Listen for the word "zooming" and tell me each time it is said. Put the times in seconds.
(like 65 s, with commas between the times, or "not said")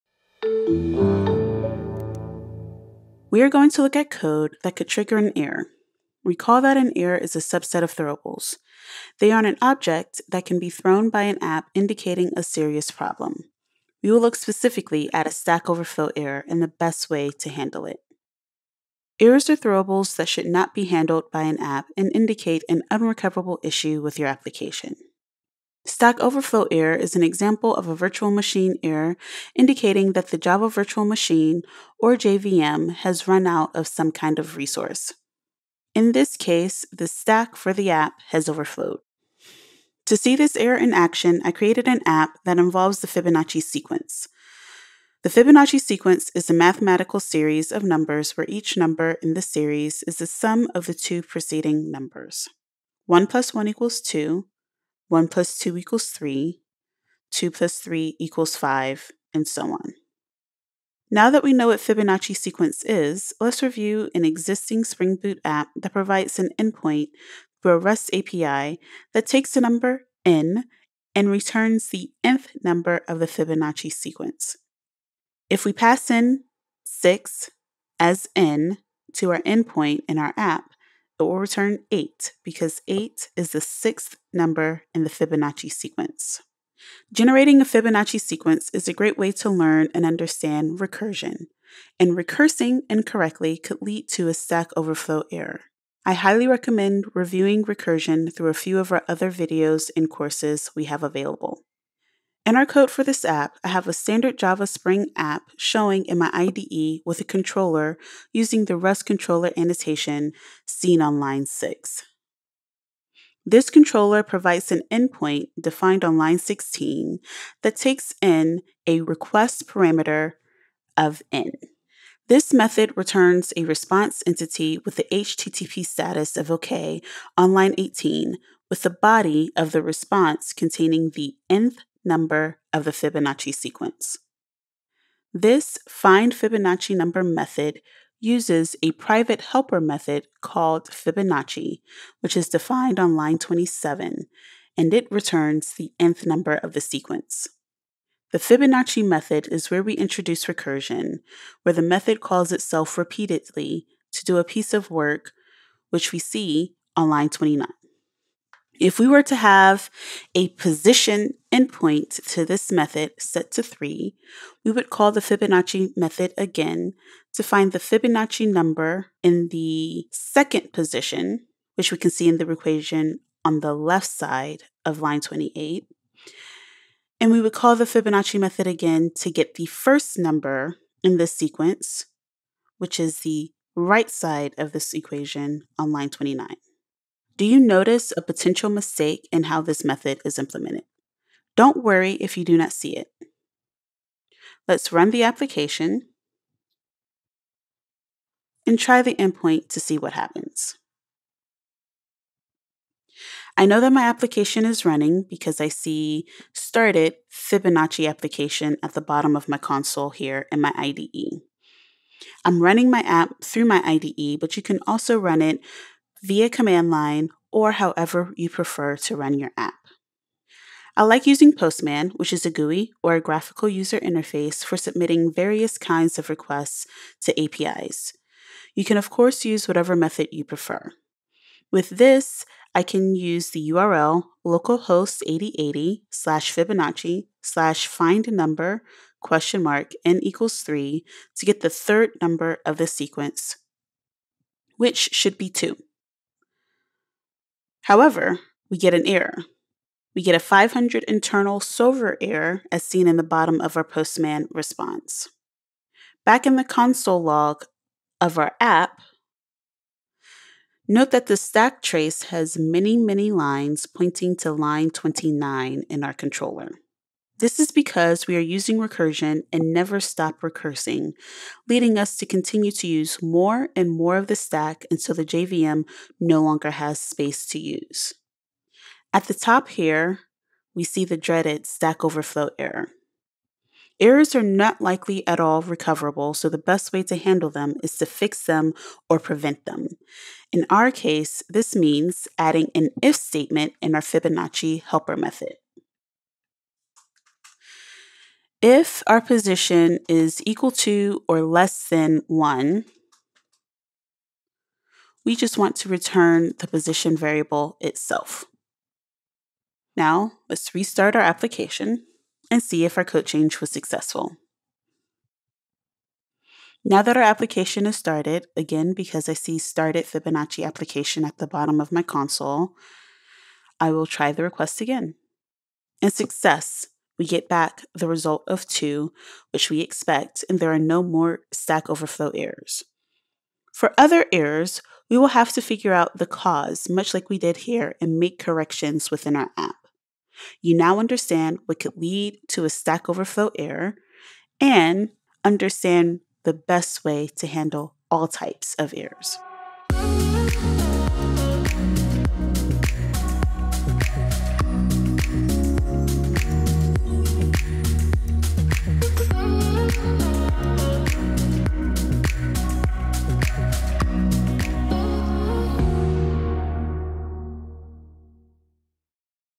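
not said.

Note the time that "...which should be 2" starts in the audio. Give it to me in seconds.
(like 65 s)
244 s.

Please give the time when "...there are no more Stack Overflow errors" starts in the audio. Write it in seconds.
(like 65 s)
330 s.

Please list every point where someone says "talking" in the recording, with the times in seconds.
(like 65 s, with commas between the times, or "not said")
not said.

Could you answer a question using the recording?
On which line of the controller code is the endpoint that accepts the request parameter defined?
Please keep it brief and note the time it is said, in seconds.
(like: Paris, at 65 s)
16, at 116 s.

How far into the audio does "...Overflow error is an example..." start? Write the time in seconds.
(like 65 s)
26 s.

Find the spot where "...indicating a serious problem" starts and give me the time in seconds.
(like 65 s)
11 s.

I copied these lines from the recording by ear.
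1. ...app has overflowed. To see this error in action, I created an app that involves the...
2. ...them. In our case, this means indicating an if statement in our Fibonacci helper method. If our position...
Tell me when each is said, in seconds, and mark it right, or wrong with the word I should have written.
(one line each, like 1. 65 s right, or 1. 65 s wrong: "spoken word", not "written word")
1. 37 s right
2. 289 s wrong: "adding", not "indicating".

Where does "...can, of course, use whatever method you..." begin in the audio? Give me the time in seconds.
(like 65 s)
228 s.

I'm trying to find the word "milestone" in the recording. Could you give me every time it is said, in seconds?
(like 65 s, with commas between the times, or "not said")
not said.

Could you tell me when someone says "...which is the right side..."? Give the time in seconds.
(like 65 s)
182 s.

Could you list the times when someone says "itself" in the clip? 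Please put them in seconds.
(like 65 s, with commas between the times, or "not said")
152 s, 307 s.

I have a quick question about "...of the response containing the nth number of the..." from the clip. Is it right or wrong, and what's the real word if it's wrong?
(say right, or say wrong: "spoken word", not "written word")
right.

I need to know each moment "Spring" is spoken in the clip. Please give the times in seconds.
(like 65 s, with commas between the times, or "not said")
64 s, 104 s.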